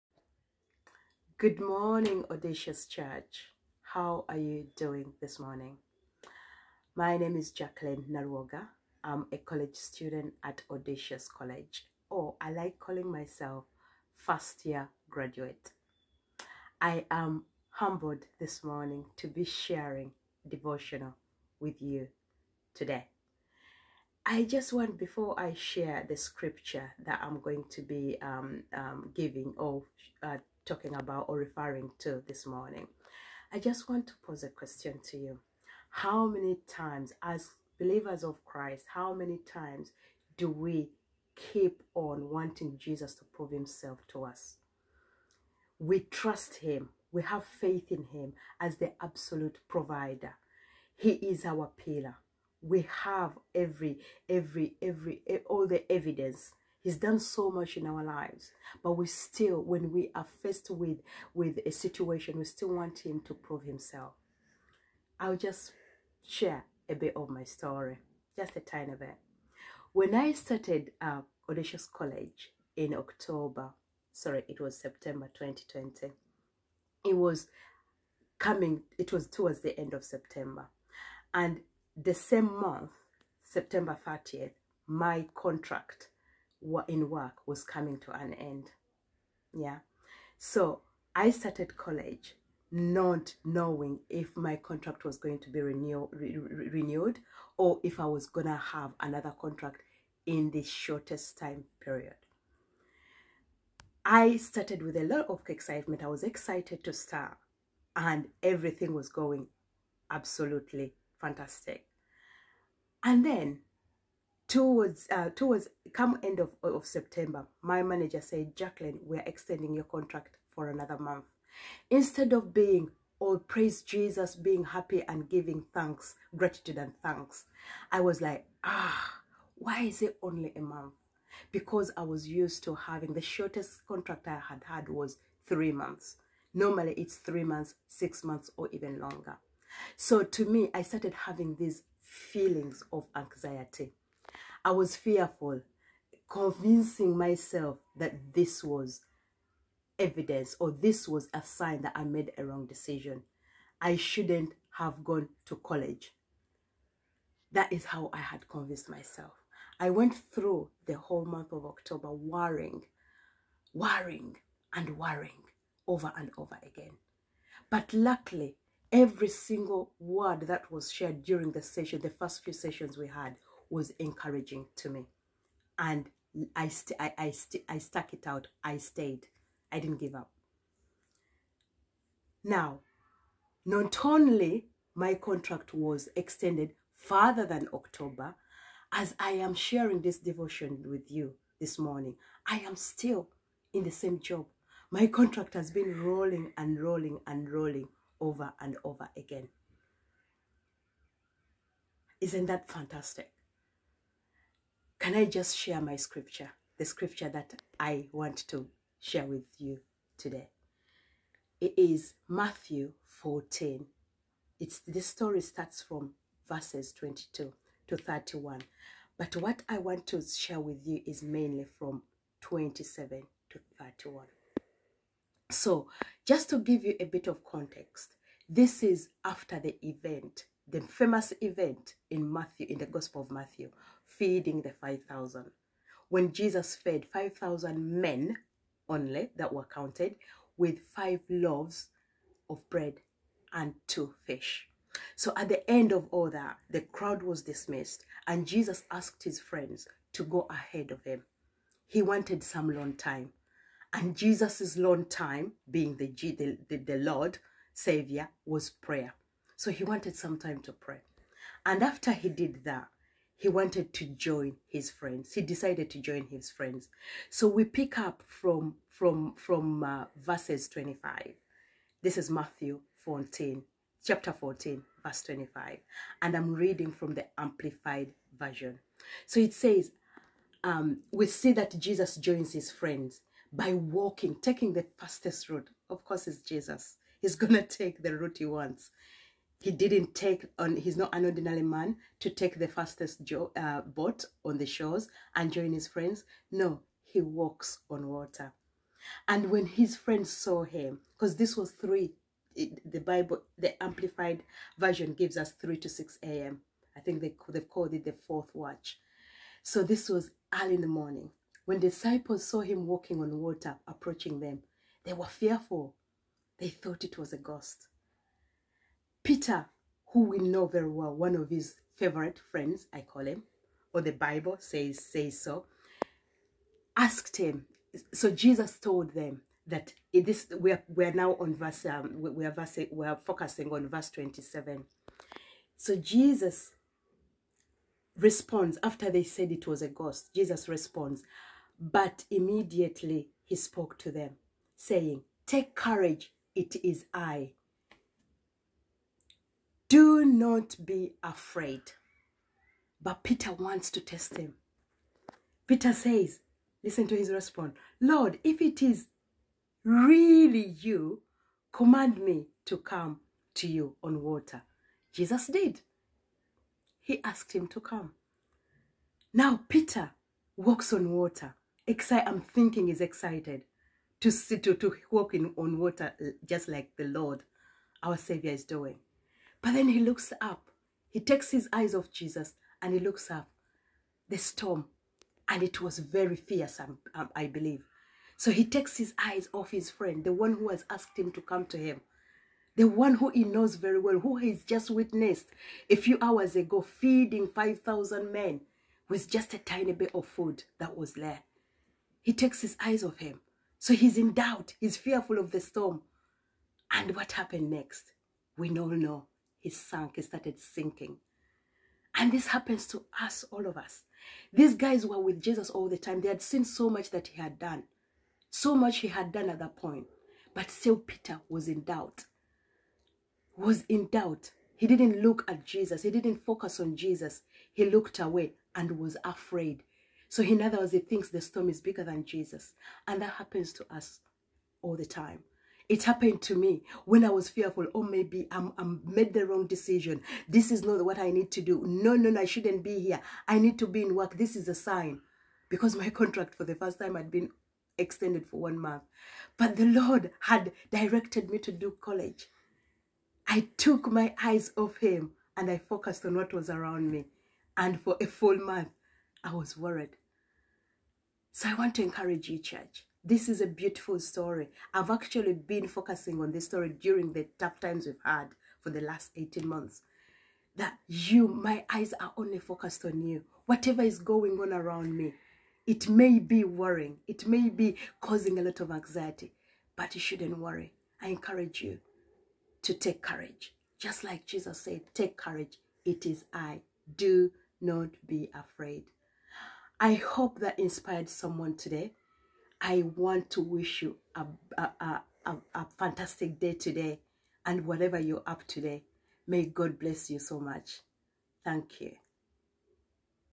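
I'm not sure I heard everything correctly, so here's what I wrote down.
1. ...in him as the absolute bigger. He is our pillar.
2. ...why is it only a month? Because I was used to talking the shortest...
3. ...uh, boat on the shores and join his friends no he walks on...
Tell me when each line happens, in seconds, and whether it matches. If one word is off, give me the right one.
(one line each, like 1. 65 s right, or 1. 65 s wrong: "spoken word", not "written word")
1. 47 s wrong: "provider", not "bigger"
2. 129 s wrong: "having", not "talking"
3. 293 s right.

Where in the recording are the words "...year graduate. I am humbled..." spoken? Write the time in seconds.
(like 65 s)
14 s.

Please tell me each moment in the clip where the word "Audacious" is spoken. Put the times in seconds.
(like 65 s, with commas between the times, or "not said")
2 s, 10 s, 71 s.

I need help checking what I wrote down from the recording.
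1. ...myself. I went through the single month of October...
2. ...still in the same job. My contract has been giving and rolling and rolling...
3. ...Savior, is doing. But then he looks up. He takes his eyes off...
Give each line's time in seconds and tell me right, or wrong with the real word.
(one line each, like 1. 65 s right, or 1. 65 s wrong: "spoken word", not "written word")
1. 158 s wrong: "whole", not "single"
2. 192 s wrong: "rolling", not "giving"
3. 378 s right.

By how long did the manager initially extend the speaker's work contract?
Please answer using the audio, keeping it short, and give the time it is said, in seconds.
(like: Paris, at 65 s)
A month, at 120 s.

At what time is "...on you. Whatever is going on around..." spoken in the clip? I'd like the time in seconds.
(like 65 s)
473 s.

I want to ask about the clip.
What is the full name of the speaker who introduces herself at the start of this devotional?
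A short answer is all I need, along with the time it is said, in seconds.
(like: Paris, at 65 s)
Jacqueline Nalwoga, at 7 s.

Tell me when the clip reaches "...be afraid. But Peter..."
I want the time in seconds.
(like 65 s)
350 s.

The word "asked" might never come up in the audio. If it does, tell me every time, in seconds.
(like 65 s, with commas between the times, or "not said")
248 s, 326 s, 367 s, 390 s.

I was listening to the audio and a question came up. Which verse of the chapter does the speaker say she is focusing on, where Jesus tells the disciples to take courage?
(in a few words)
Verse 27.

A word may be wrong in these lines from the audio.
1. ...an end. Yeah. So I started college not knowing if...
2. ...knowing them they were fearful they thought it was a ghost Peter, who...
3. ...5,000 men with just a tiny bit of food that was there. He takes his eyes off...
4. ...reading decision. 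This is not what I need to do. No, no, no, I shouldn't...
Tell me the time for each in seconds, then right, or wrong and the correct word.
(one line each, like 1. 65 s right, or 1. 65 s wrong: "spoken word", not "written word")
1. 88 s right
2. 313 s wrong: "approaching", not "knowing"
3. 397 s right
4. 439 s wrong: "wrong", not "reading".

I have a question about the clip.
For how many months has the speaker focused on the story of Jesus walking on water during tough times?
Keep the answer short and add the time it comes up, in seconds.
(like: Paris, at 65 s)
18 months, at 469 s.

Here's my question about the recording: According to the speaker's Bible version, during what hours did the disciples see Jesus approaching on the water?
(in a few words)
3 to 6 a.m.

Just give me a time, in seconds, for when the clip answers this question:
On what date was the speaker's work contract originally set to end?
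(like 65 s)
83 s.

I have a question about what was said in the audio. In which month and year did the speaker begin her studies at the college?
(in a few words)
September 2020.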